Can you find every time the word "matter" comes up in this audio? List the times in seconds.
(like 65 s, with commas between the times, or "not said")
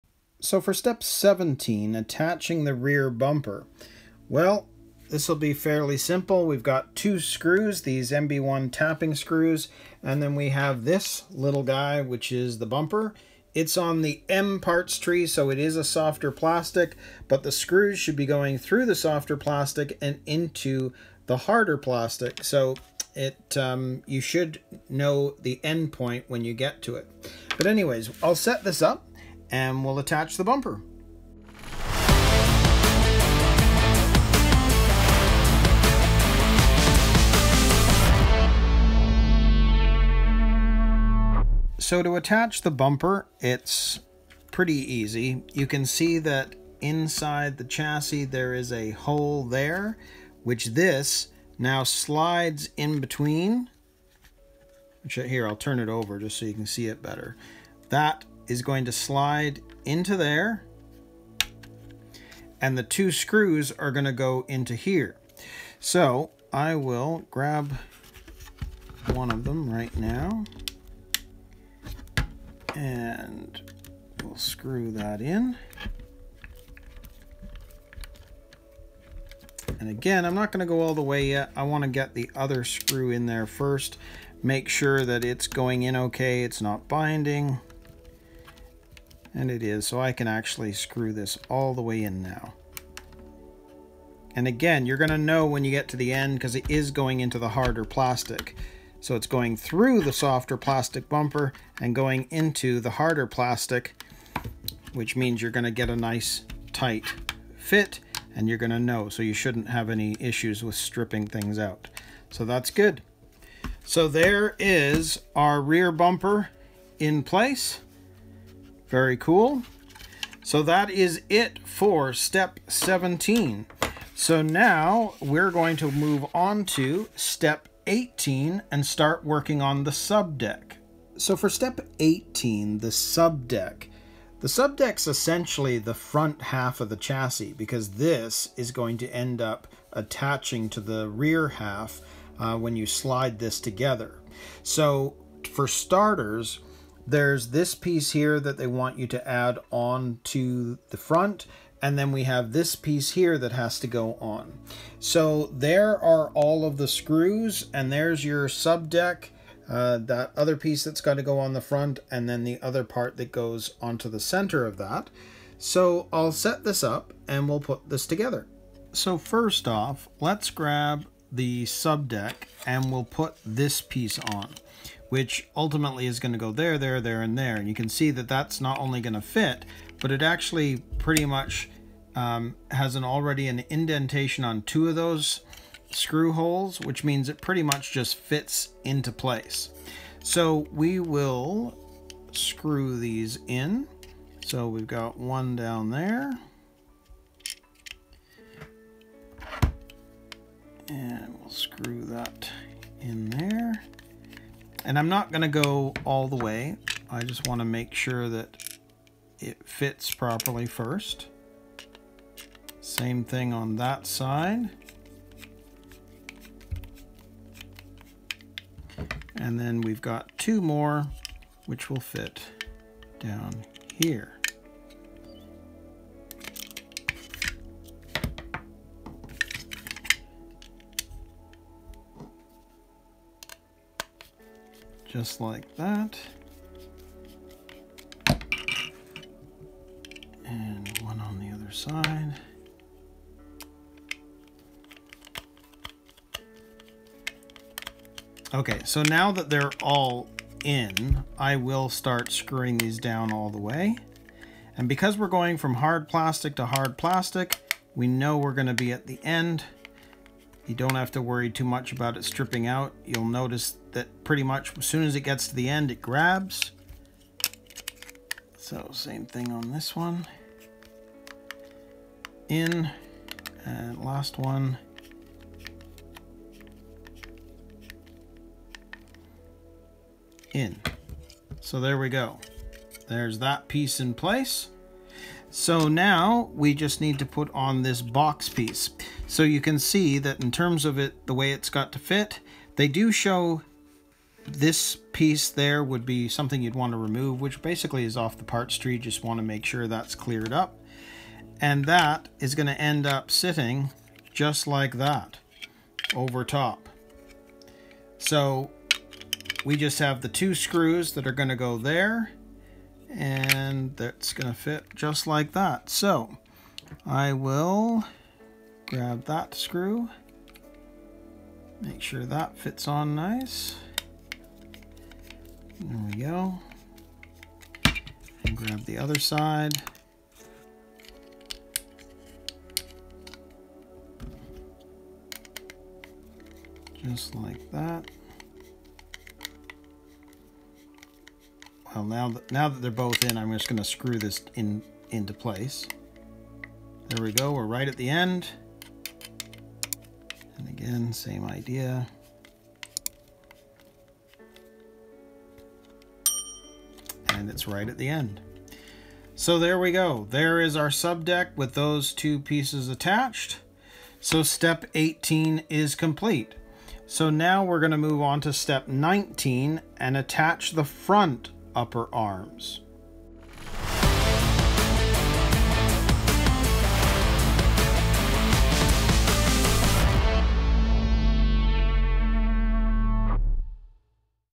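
not said.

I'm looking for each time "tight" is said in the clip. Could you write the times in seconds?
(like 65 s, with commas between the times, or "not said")
106 s.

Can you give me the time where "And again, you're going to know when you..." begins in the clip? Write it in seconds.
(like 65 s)
94 s.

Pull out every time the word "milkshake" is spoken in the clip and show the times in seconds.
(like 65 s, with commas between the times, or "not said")
not said.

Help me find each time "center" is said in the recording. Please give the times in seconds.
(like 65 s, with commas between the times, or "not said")
164 s.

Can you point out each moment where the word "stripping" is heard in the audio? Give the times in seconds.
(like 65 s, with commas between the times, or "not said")
110 s, 262 s.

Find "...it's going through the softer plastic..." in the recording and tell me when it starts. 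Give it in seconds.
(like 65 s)
99 s.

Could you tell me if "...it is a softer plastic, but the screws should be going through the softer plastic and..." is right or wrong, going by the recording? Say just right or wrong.
right.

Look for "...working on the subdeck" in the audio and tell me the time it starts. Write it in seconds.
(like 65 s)
129 s.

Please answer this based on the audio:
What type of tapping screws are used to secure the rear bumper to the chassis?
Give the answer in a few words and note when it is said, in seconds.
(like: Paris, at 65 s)
MB1, at 8 s.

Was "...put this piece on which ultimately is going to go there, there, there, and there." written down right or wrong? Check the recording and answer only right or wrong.
right.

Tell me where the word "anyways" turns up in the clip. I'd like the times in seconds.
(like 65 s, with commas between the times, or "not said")
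27 s.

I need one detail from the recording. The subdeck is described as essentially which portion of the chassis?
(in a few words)
front half.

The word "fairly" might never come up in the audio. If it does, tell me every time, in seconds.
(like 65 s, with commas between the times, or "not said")
5 s.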